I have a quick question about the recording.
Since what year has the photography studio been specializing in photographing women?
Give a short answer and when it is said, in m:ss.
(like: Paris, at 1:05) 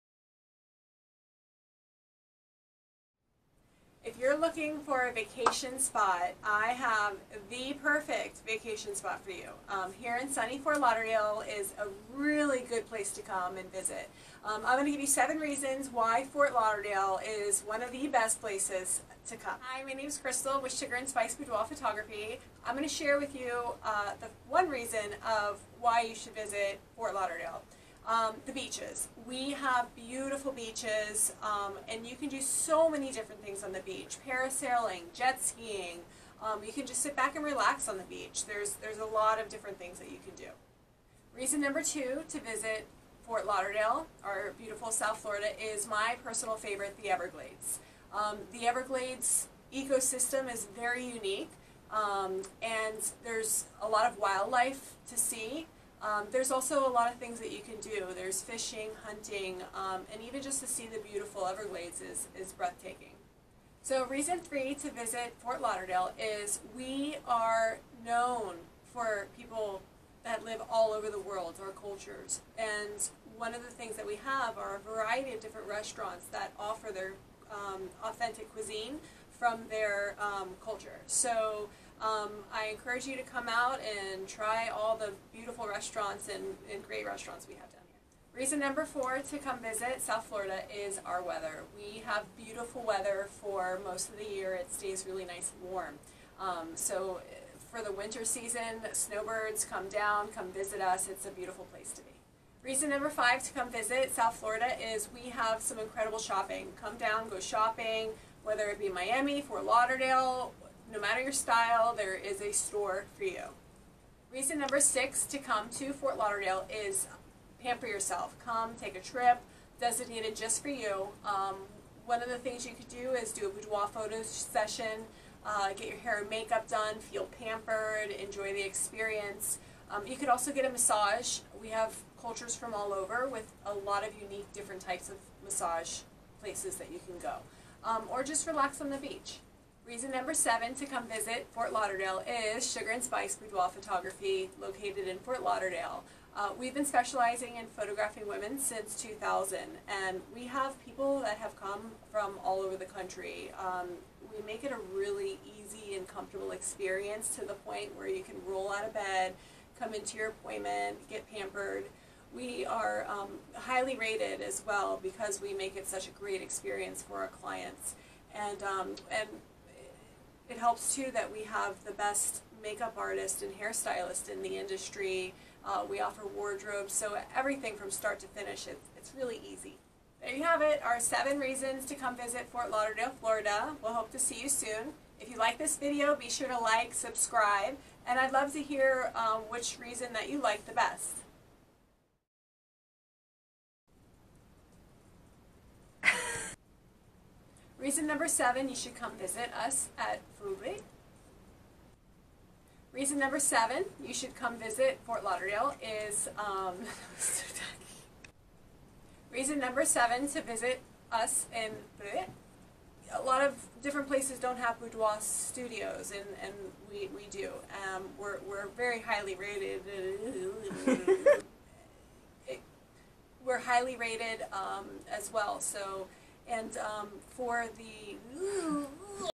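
2000, at 2:29.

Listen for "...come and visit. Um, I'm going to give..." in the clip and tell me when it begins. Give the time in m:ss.
0:13.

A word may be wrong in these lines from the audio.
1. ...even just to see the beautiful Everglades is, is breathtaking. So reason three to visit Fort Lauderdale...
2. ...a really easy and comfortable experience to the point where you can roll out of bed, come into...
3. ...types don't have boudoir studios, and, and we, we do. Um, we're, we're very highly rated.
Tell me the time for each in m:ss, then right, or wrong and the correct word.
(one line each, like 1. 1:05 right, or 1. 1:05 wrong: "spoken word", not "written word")
1. 1:00 right
2. 2:34 right
3. 3:34 wrong: "places", not "types".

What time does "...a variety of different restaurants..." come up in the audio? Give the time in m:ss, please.
1:14.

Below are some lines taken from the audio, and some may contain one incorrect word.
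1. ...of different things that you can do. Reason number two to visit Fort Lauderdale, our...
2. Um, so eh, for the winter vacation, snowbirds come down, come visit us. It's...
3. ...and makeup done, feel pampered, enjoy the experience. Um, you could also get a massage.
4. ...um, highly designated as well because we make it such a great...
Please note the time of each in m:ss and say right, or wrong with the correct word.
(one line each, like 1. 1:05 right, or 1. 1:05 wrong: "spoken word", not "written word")
1. 0:39 right
2. 1:36 wrong: "season", not "vacation"
3. 2:06 right
4. 2:43 wrong: "rated", not "designated".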